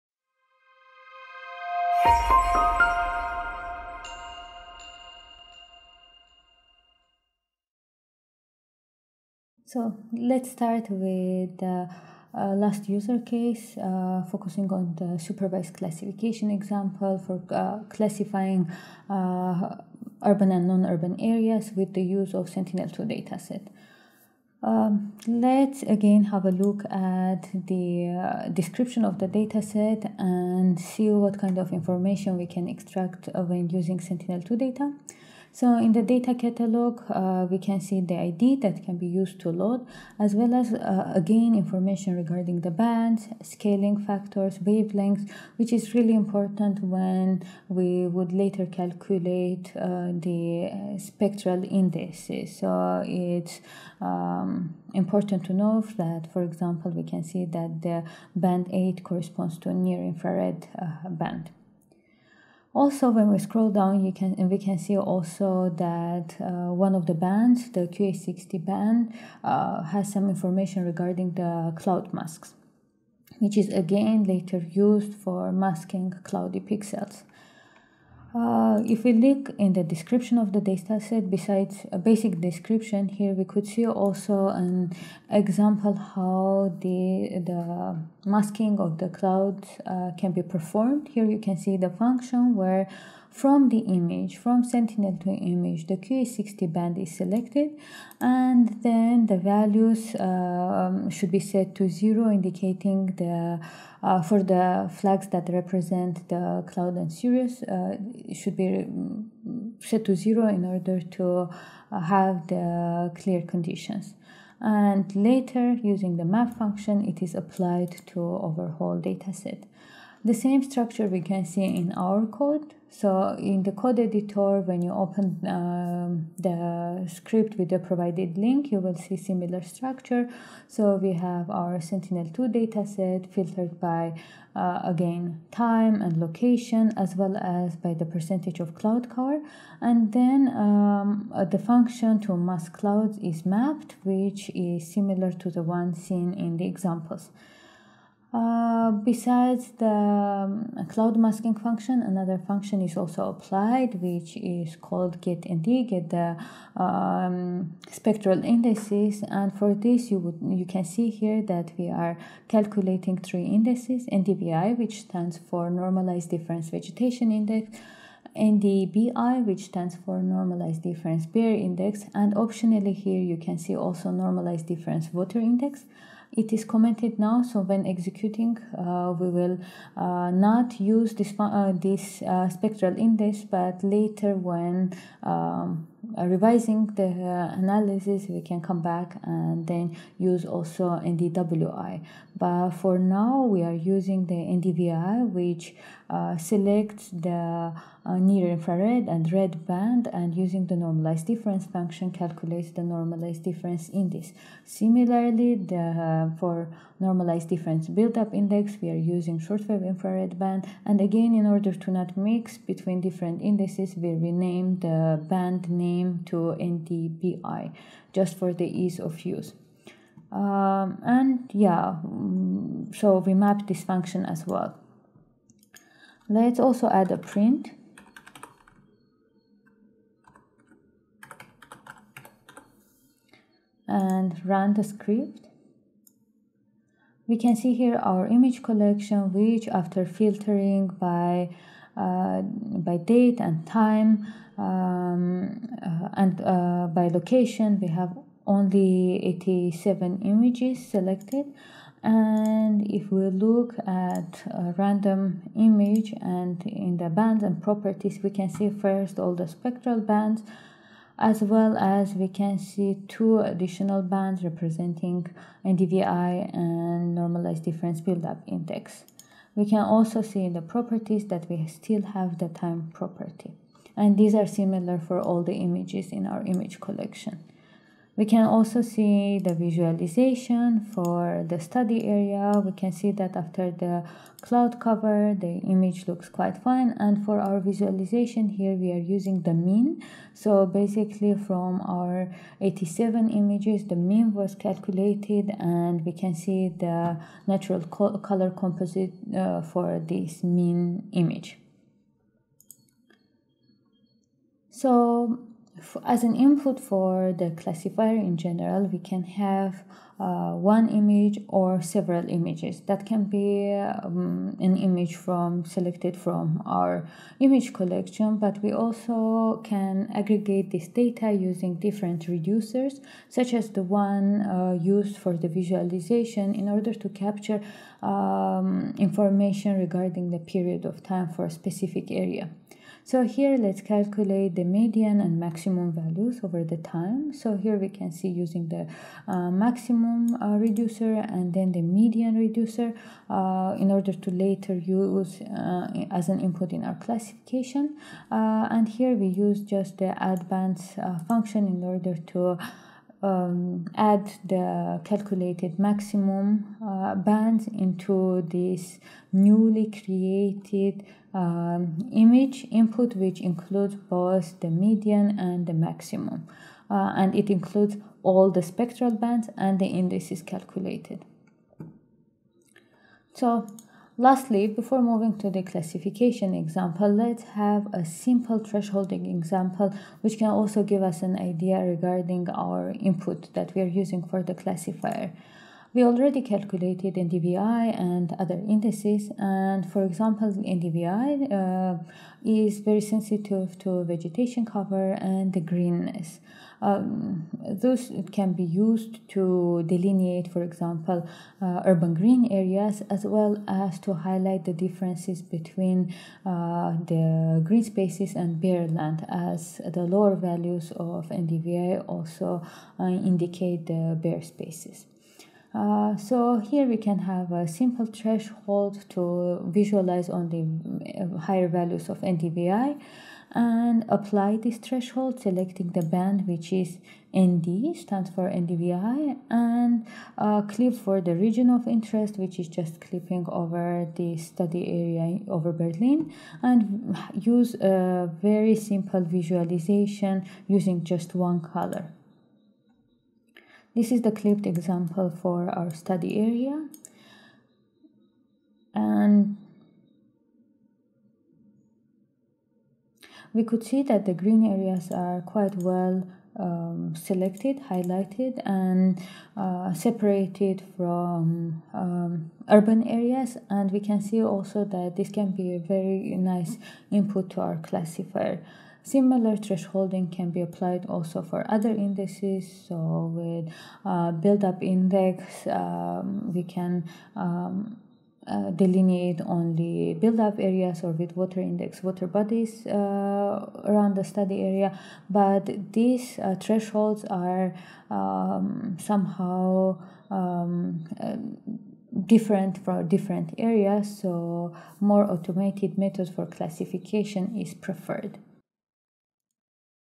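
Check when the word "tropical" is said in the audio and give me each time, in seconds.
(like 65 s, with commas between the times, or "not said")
not said.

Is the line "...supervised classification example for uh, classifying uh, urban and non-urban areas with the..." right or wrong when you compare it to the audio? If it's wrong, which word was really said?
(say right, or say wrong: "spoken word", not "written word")
right.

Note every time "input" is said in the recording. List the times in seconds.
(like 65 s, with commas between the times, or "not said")
306 s, 346 s, 362 s, 382 s, 467 s.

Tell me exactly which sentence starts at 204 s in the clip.
Similarly, the, uh, for normalized difference buildup index, we are using shortwave infrared band.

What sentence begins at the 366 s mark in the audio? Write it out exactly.
Uh, and it includes all the spectral bands and the indices calculated.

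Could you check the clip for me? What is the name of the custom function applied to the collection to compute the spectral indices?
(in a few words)
getND.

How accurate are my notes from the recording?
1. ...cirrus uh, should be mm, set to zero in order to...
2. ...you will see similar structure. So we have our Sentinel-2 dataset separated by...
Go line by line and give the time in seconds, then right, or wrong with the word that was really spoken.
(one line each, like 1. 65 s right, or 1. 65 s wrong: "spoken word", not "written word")
1. 107 s right
2. 128 s wrong: "filtered", not "separated".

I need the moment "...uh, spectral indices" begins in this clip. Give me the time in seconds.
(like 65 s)
50 s.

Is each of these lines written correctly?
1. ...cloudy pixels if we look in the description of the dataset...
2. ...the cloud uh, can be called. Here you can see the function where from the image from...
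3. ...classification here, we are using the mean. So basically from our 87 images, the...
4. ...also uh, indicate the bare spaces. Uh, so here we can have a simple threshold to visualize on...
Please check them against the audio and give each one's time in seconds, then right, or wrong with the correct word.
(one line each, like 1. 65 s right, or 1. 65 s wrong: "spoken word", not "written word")
1. 76 s right
2. 88 s wrong: "performed", not "called"
3. 287 s wrong: "visualization", not "classification"
4. 412 s right.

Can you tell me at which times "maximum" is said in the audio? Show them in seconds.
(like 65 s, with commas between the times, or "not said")
335 s, 339 s, 355 s, 365 s.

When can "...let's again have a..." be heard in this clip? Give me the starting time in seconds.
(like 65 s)
25 s.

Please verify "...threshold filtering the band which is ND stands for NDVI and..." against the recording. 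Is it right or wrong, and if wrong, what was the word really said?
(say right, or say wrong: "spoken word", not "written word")
wrong: "selecting", not "filtering".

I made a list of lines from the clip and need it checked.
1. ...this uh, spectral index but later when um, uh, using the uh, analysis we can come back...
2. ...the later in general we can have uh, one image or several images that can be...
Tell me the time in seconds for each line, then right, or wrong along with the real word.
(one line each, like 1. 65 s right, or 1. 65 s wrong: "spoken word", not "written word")
1. 181 s wrong: "revising", not "using"
2. 307 s wrong: "classifier", not "later".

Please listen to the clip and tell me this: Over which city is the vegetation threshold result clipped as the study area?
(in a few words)
Berlin.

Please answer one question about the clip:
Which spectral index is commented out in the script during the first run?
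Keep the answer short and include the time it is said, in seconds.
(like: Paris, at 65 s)
Normalized Difference Water Index, at 174 s.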